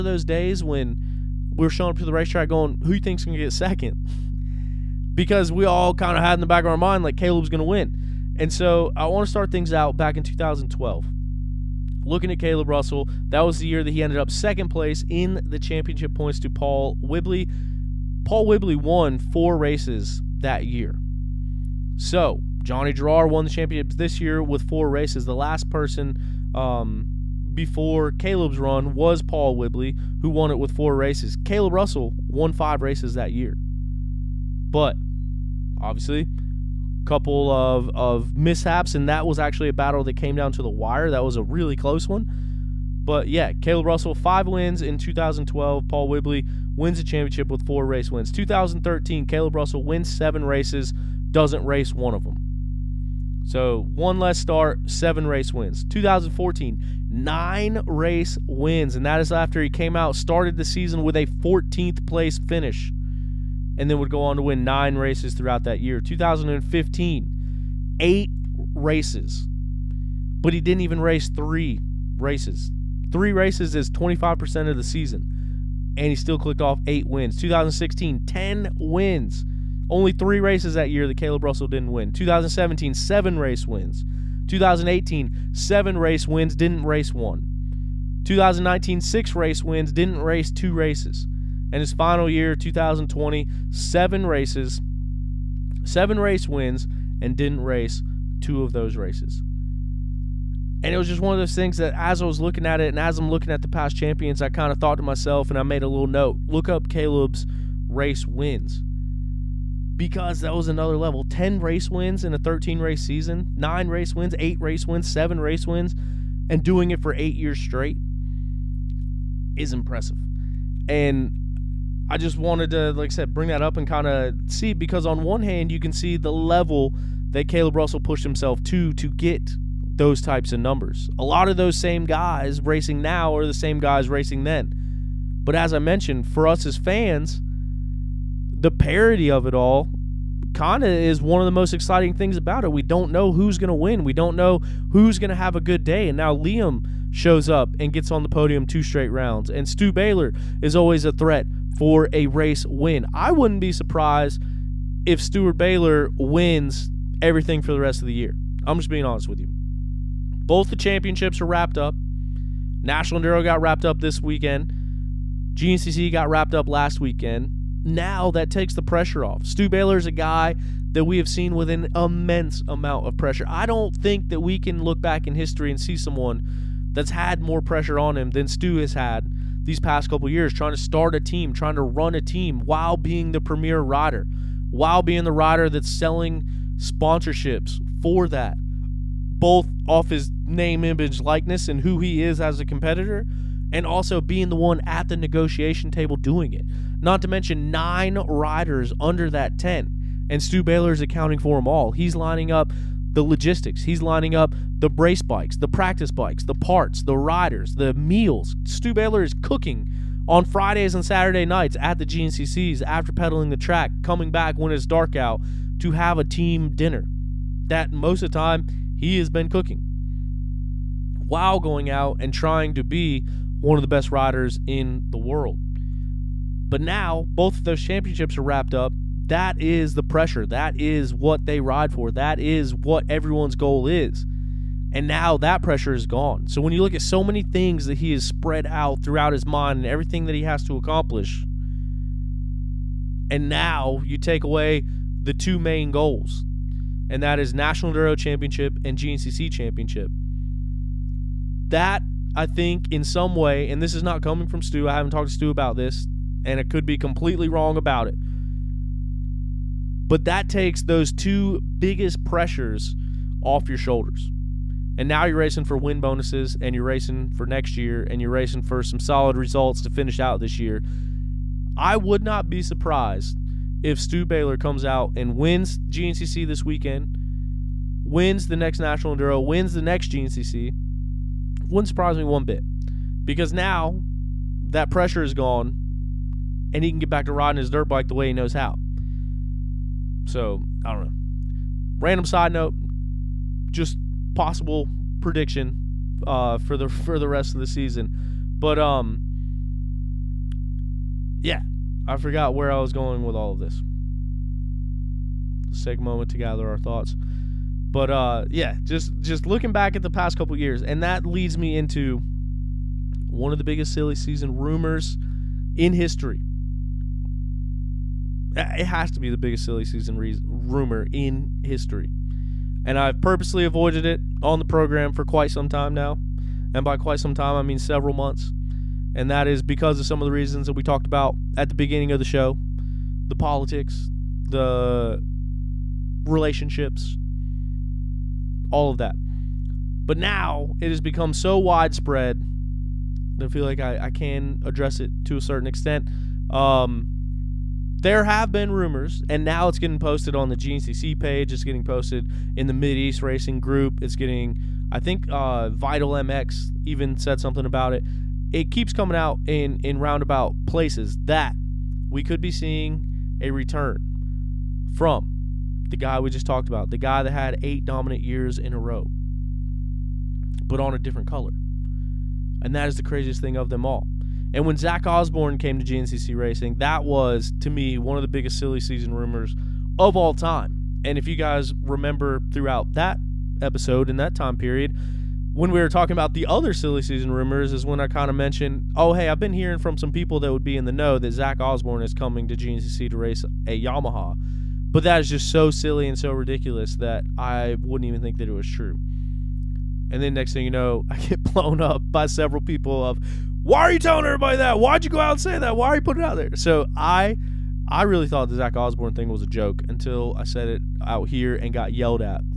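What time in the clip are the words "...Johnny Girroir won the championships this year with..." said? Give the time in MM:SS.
00:22.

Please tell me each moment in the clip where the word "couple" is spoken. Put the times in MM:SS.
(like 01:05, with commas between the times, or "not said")
00:37, 03:00, 05:10.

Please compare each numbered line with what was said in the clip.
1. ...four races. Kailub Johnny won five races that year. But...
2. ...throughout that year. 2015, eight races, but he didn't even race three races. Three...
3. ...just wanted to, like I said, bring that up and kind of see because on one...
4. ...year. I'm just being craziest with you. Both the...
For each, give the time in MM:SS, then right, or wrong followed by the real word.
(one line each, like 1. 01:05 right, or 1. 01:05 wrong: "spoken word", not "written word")
1. 00:30 wrong: "Russell", not "Johnny"
2. 01:05 right
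3. 02:02 right
4. 02:38 wrong: "honest", not "craziest".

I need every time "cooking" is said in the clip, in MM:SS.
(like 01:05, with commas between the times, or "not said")
03:29, 03:39.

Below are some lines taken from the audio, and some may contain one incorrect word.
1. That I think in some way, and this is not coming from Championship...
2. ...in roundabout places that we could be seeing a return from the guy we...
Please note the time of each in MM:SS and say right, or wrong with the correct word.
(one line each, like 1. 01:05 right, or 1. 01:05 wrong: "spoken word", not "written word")
1. 04:11 wrong: "Stu", not "Championship"
2. 05:59 right.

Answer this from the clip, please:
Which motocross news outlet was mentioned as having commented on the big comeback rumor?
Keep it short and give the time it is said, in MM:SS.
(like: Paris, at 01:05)
Vital MX, at 05:55.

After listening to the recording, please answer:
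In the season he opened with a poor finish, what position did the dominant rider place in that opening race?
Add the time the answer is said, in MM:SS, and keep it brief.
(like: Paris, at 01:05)
14th, at 01:01.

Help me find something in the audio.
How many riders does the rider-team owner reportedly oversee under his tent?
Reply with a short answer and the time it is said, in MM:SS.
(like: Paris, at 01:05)
9, at 03:17.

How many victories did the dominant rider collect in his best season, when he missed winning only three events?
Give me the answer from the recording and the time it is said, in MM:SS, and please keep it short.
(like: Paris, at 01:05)
10, at 01:18.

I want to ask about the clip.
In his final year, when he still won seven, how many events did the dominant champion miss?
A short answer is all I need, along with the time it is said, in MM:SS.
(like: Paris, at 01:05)
2, at 01:37.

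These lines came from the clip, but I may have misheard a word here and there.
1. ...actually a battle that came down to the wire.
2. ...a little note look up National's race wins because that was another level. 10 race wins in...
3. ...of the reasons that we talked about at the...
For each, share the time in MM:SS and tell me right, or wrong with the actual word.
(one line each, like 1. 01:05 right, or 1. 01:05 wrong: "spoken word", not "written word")
1. 00:39 right
2. 01:45 wrong: "Kailub", not "National"
3. 05:30 right.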